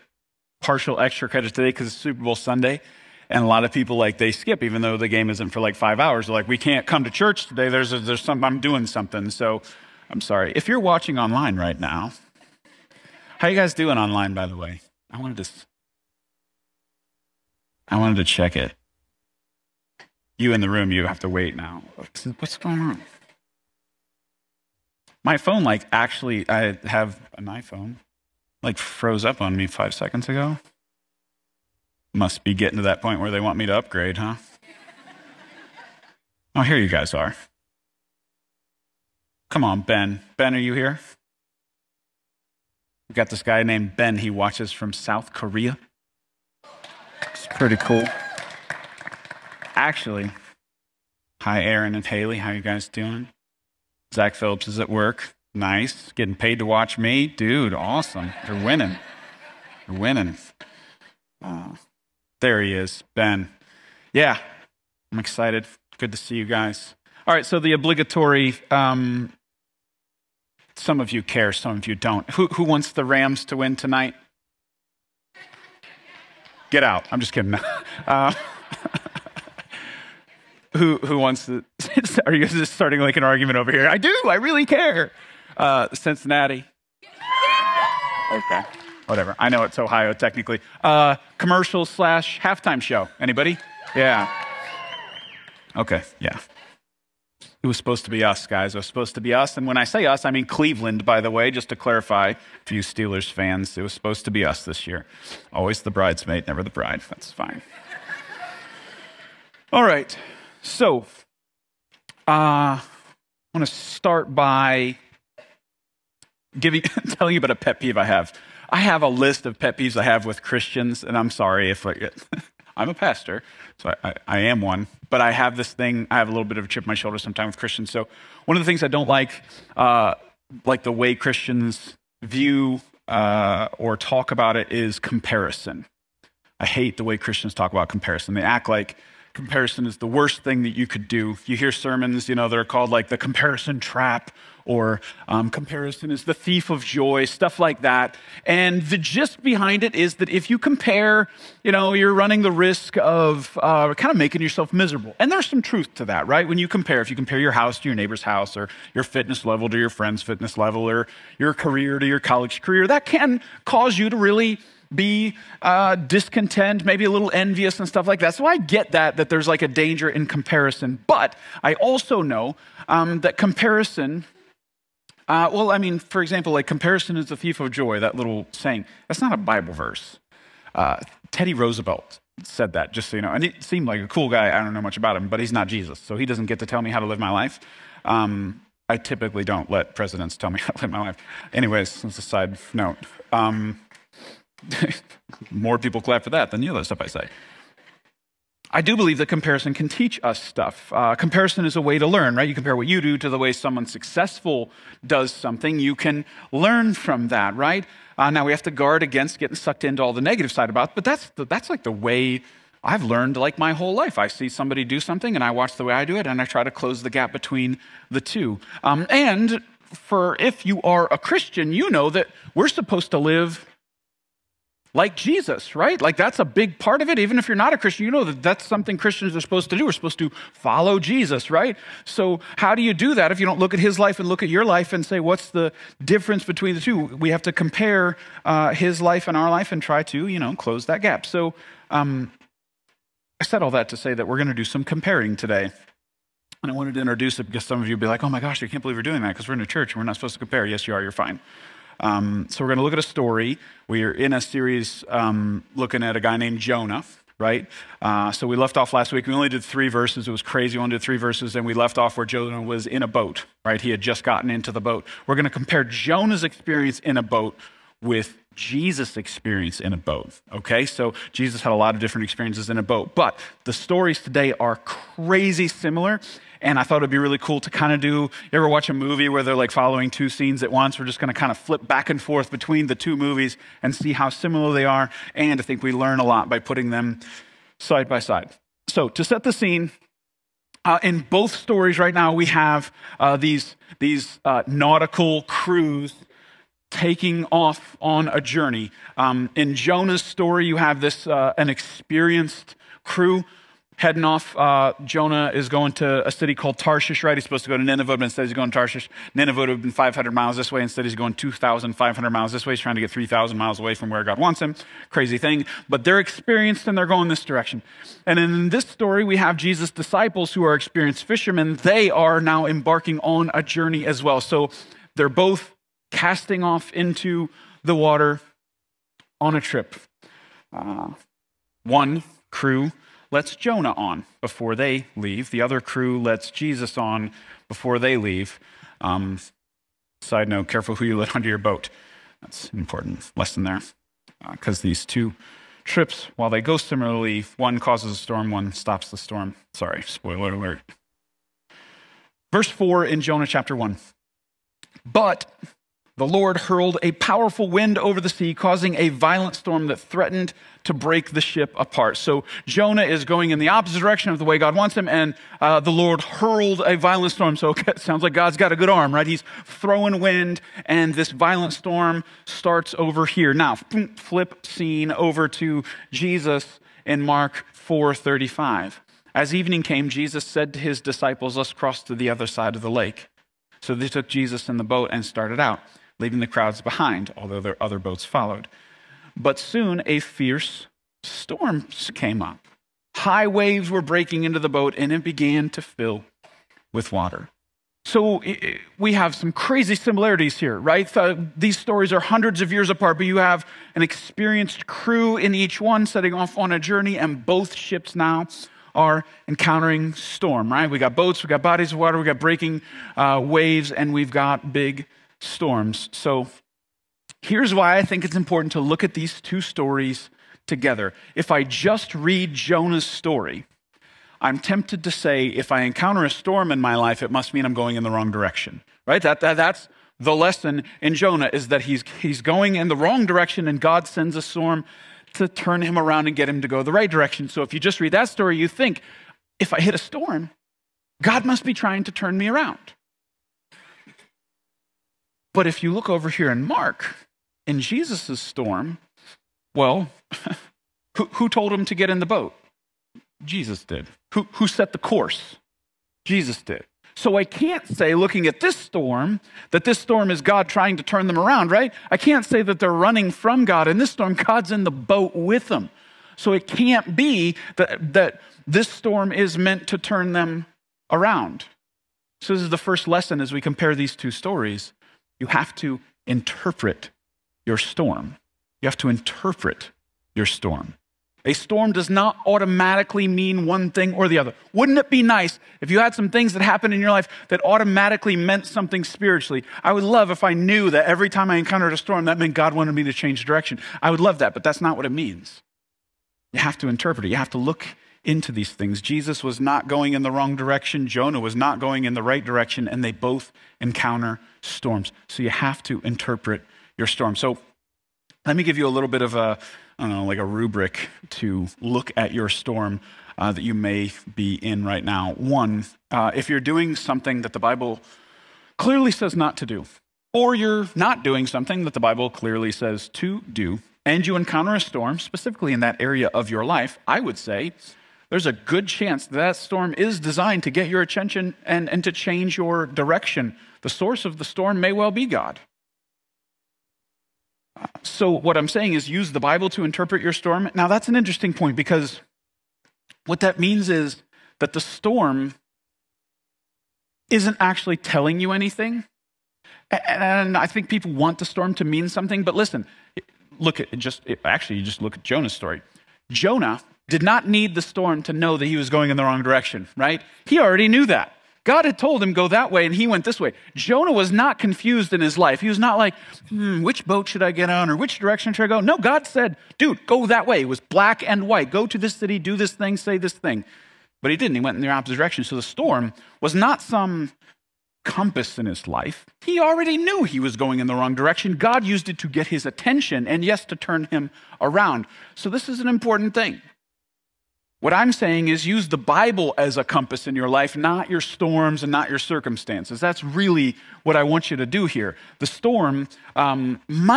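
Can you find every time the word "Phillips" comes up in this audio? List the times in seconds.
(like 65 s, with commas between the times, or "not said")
54 s.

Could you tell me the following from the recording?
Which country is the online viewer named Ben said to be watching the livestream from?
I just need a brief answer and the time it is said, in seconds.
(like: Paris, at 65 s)
South Korea, at 44 s.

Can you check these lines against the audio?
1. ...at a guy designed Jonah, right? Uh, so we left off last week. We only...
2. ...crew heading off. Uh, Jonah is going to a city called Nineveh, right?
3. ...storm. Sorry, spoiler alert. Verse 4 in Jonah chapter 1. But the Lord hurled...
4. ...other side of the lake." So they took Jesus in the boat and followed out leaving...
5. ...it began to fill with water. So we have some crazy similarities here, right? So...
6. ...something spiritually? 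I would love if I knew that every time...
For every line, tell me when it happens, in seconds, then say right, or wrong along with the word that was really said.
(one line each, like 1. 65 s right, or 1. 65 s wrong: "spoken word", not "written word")
1. 256 s wrong: "named", not "designed"
2. 303 s wrong: "Tarshish", not "Nineveh"
3. 349 s right
4. 382 s wrong: "started", not "followed"
5. 395 s right
6. 488 s right.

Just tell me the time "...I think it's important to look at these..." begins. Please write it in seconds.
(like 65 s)
417 s.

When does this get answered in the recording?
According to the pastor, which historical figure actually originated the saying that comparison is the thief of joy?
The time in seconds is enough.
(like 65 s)
181 s.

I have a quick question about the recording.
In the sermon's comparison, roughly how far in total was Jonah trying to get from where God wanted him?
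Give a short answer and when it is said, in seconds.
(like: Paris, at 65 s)
3,000 miles, at 313 s.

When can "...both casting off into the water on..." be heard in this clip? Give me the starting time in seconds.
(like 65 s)
325 s.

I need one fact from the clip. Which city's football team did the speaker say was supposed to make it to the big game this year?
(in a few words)
Cleveland.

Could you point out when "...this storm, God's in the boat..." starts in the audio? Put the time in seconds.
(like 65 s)
463 s.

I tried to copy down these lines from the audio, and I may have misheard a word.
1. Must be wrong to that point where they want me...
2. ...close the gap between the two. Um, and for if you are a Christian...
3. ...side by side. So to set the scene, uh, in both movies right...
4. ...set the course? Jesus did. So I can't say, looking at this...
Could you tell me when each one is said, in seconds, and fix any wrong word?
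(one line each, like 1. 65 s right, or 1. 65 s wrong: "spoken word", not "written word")
1. 32 s wrong: "getting", not "wrong"
2. 216 s right
3. 287 s wrong: "stories", not "movies"
4. 454 s right.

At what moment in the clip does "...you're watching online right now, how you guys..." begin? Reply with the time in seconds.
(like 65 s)
10 s.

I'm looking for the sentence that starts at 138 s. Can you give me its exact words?
They act like comparison is the worst thing that you could do.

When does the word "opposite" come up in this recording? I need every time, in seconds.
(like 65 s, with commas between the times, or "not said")
363 s, 574 s.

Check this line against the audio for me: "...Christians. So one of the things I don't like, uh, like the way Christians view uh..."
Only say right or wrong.
right.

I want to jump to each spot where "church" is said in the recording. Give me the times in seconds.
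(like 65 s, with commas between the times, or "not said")
7 s, 249 s.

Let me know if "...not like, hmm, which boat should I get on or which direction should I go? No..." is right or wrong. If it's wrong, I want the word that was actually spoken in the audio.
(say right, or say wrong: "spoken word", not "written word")
right.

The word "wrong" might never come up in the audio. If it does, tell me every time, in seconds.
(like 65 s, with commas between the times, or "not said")
428 s, 432 s, 500 s, 559 s, 580 s.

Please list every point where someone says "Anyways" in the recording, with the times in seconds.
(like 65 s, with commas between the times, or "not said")
191 s.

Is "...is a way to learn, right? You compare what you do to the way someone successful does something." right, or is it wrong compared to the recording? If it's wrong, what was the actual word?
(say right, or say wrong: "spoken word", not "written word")
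right.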